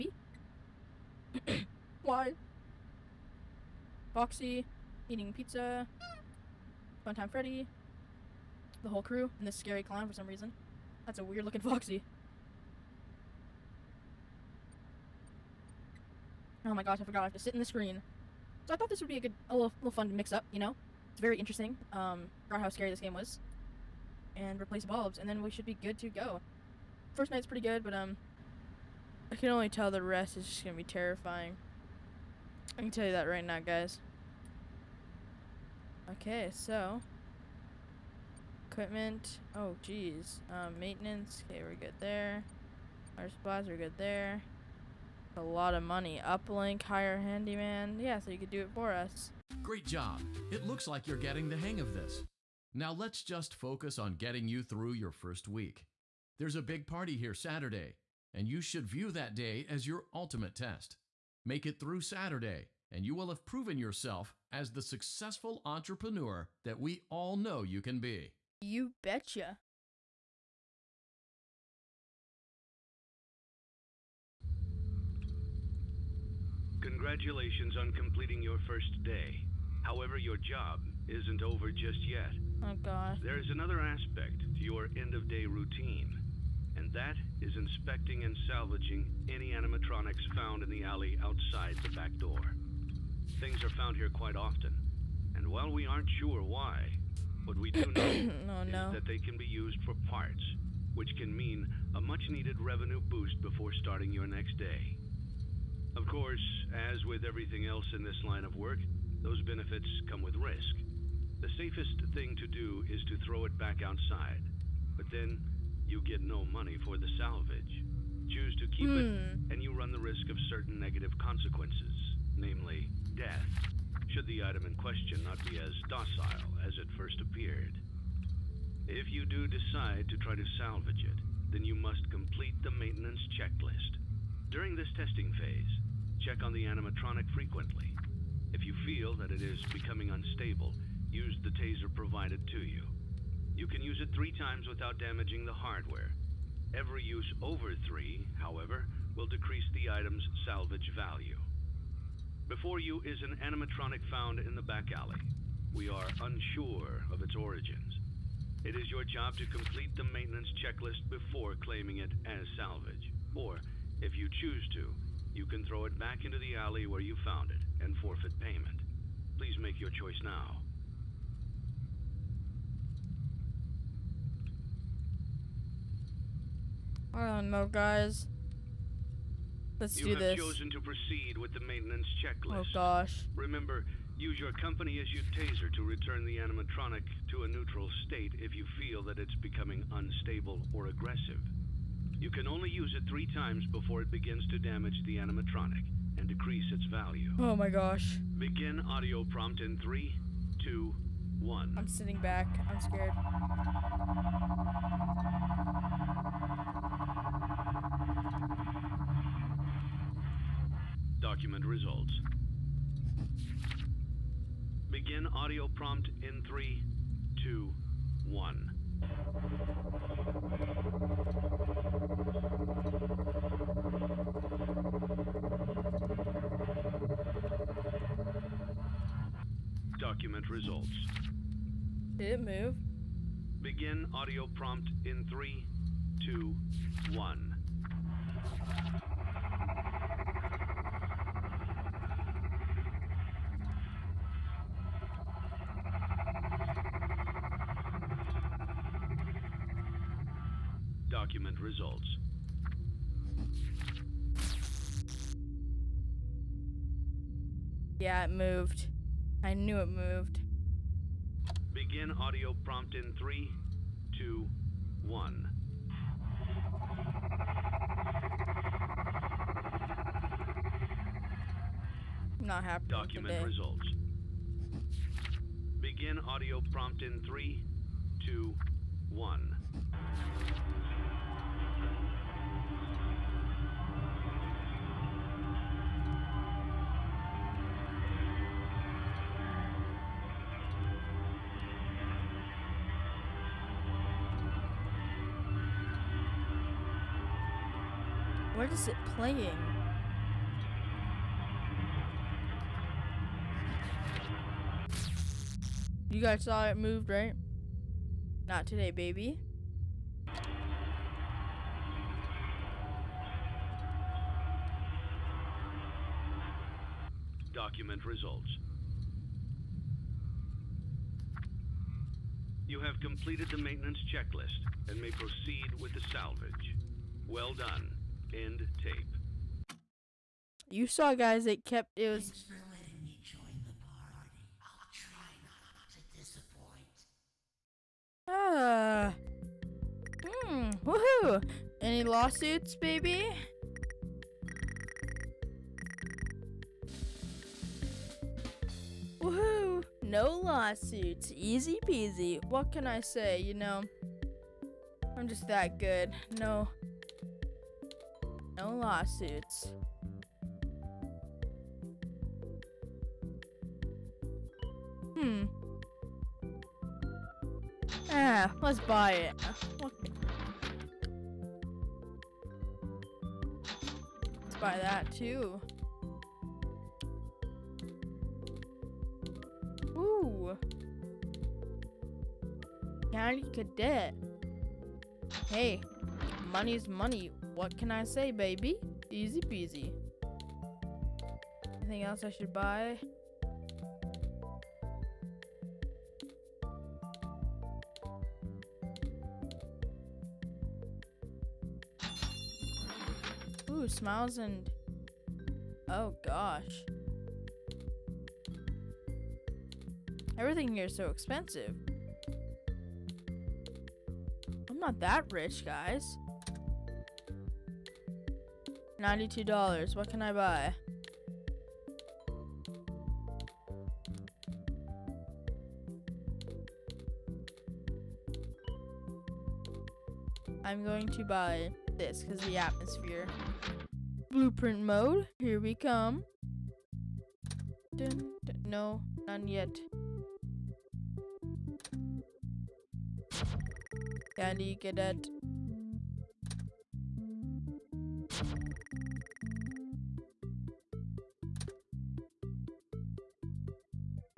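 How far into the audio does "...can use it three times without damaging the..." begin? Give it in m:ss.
2:23.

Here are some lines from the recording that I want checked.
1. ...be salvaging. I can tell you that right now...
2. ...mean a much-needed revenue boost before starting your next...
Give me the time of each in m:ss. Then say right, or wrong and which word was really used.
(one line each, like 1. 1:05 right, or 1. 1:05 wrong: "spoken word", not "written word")
1. 0:30 wrong: "terrifying", not "salvaging"
2. 1:41 right.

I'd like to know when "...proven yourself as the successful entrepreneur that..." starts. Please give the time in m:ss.
1:03.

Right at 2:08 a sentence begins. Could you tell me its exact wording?
If you do decide to try to salvage it, then you must complete the maintenance checklist.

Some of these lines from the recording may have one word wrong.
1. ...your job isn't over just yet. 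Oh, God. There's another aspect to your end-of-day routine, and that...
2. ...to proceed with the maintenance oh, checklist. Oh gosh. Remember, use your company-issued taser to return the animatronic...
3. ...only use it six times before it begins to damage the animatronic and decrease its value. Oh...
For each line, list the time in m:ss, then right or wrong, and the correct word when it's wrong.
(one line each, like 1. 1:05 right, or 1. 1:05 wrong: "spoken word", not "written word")
1. 1:20 right
2. 3:00 right
3. 3:12 wrong: "three", not "six".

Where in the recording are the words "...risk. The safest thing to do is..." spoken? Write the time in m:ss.
1:50.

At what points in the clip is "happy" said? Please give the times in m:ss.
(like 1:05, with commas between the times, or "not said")
4:32.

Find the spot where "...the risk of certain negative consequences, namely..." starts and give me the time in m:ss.
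1:59.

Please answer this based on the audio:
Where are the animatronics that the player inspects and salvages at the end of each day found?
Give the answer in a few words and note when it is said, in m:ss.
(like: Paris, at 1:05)
the alley outside the back door, at 1:30.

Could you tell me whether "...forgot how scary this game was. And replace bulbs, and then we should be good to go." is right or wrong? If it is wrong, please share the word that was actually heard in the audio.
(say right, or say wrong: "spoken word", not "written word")
right.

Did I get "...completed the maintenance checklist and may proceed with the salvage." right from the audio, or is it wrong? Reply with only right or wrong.
right.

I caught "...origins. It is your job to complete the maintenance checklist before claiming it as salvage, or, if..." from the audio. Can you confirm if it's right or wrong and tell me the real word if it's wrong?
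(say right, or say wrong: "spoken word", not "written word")
right.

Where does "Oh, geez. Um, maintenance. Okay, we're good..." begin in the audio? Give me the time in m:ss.
0:39.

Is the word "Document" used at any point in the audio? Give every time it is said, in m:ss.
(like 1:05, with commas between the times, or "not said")
3:31, 4:11, 4:32, 5:17.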